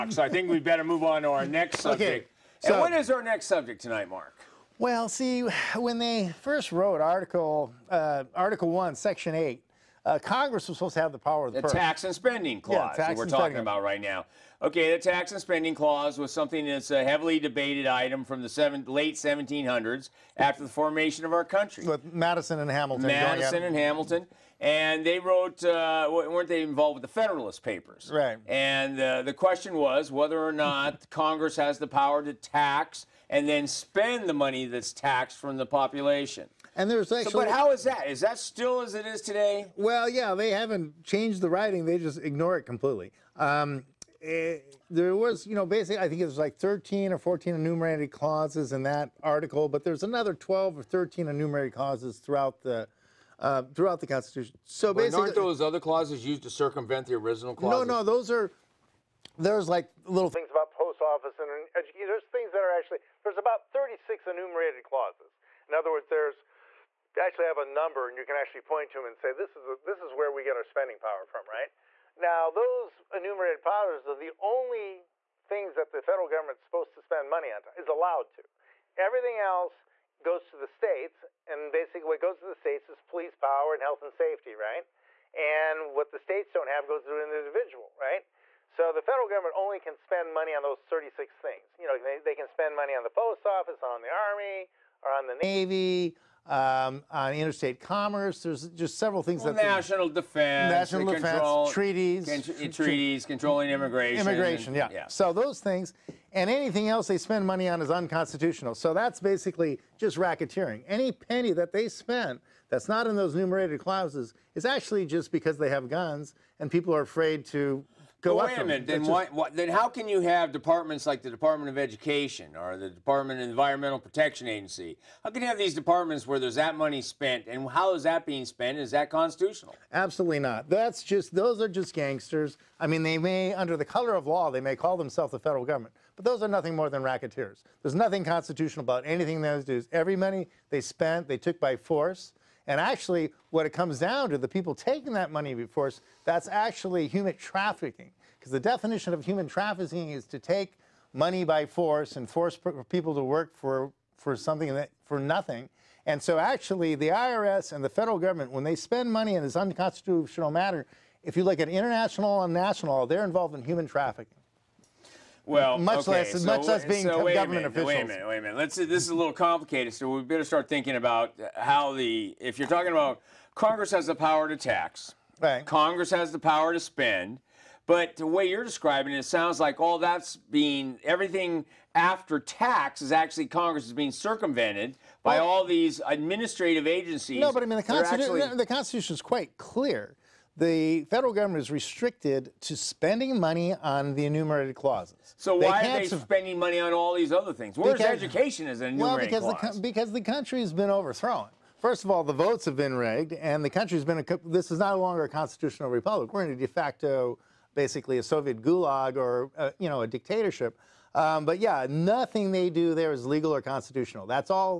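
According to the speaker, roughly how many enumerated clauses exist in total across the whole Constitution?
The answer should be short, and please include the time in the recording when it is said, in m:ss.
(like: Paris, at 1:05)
36, at 1:03.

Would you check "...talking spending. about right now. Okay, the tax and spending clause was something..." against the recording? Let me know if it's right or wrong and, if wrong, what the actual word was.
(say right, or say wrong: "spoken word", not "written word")
right.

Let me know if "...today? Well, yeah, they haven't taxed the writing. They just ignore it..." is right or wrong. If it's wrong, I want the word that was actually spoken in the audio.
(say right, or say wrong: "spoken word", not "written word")
wrong: "changed", not "taxed".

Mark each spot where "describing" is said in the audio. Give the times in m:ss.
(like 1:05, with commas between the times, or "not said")
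2:58.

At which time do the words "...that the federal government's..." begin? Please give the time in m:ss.
1:15.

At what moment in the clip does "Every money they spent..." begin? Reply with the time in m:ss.
2:19.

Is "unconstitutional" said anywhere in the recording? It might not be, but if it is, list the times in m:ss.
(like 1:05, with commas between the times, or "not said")
1:47, 2:39.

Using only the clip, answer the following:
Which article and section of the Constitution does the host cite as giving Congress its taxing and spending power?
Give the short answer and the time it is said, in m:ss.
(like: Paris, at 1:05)
Article One, Section Eight, at 0:08.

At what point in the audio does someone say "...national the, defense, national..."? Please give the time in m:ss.
1:39.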